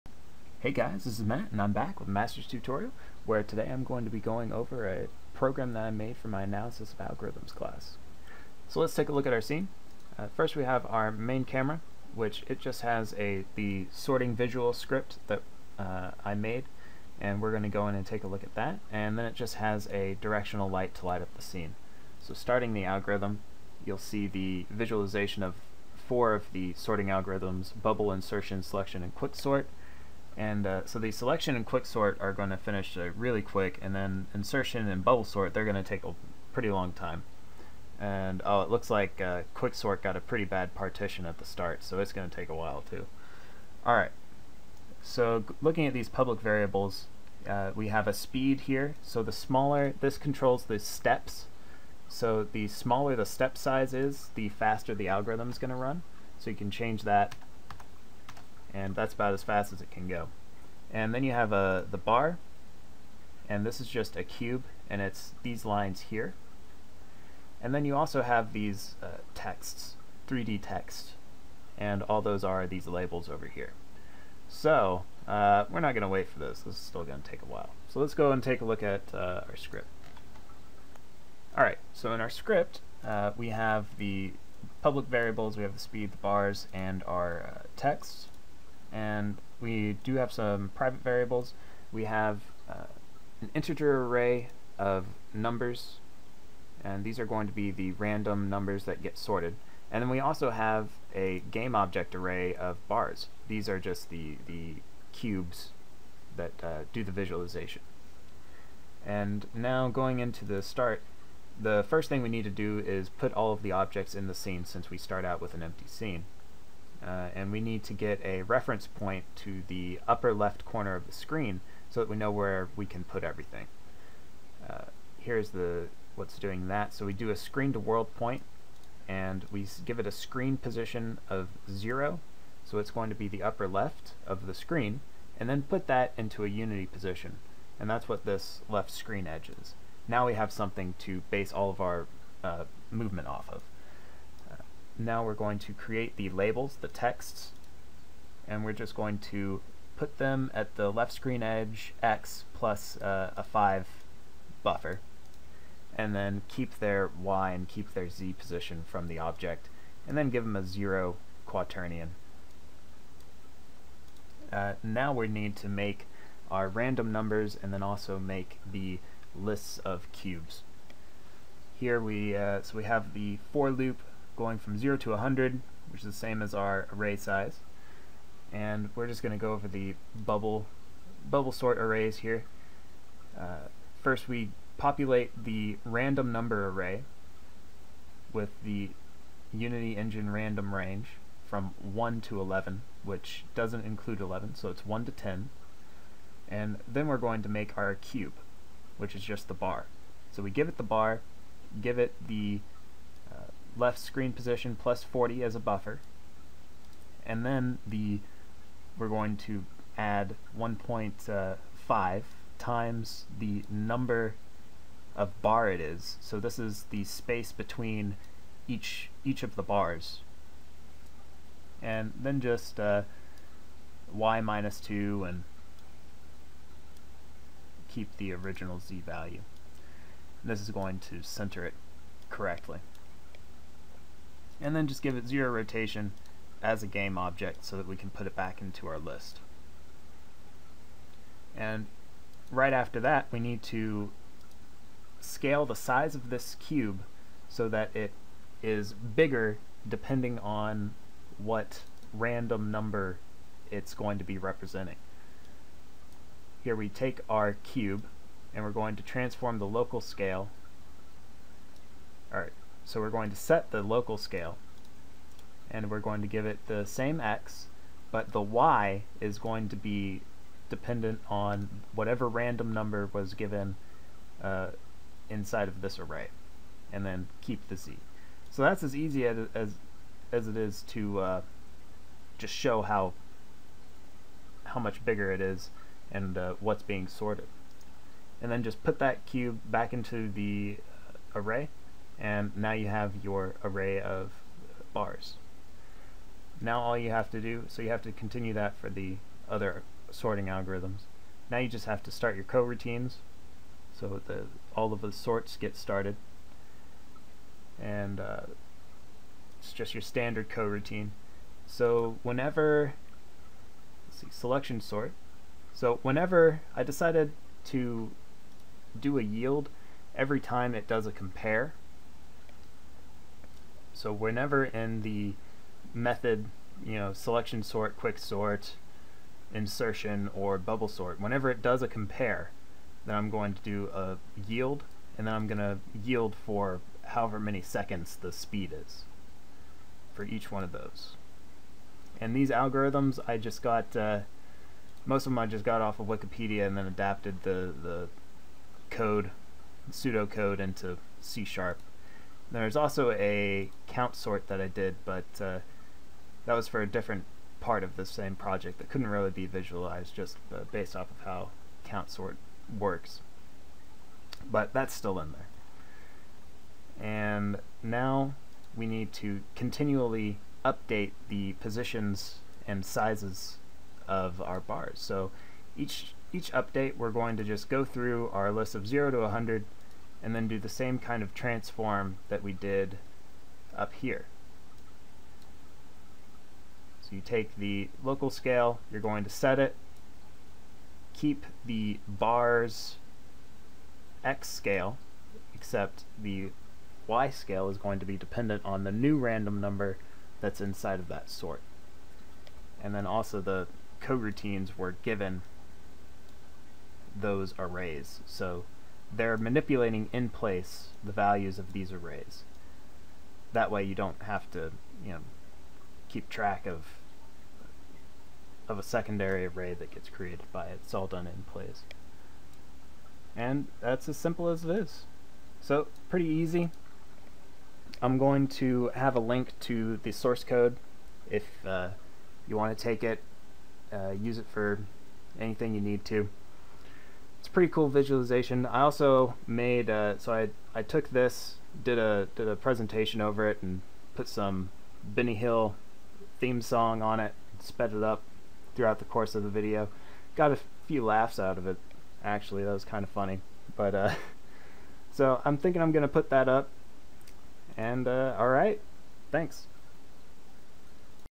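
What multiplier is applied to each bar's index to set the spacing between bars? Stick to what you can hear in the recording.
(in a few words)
1.5.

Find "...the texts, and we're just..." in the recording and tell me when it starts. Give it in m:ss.
2:26.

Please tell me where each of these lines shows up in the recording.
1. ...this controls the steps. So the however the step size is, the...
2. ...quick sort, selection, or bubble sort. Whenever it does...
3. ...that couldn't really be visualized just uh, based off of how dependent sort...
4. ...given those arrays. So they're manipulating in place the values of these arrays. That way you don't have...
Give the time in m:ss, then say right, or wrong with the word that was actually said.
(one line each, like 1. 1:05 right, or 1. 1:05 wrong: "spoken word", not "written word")
1. 0:49 wrong: "smaller", not "however"
2. 5:27 wrong: "insertion", not "selection"
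3. 5:58 wrong: "count", not "dependent"
4. 6:45 right.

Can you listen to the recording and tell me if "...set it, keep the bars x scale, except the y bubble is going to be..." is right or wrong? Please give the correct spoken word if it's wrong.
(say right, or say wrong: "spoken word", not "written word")
wrong: "scale", not "bubble".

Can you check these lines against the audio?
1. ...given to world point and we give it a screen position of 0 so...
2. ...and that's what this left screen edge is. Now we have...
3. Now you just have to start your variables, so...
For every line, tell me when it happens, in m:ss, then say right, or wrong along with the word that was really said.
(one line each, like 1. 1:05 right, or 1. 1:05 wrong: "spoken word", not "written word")
1. 2:07 wrong: "screen", not "given"
2. 2:17 right
3. 5:01 wrong: "coroutines", not "variables".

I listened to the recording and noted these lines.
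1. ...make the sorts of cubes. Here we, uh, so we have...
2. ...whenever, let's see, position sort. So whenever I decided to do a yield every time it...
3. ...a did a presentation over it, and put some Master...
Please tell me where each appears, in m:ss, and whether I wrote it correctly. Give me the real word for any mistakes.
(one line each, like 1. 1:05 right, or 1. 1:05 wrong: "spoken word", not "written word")
1. 2:48 wrong: "lists", not "sorts"
2. 5:12 wrong: "selection", not "position"
3. 7:21 wrong: "Benny", not "Master".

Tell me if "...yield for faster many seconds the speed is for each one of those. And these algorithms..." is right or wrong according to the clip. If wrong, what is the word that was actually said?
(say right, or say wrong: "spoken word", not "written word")
wrong: "however", not "faster".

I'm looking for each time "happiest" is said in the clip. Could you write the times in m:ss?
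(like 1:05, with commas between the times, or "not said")
not said.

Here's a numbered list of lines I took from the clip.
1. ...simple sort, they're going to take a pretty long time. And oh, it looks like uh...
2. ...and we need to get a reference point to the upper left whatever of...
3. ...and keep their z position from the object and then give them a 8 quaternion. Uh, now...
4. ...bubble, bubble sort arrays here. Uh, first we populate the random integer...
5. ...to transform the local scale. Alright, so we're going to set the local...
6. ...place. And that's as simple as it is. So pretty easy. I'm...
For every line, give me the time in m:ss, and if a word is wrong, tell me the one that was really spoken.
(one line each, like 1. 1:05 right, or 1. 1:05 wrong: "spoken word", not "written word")
1. 0:35 wrong: "bubble", not "simple"
2. 1:57 wrong: "corner", not "whatever"
3. 2:37 wrong: "0", not "8"
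4. 3:00 wrong: "number", not "integer"
5. 4:18 right
6. 7:01 right.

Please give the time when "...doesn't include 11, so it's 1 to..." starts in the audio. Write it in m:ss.
3:13.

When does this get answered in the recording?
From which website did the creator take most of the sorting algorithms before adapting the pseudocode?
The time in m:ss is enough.
5:46.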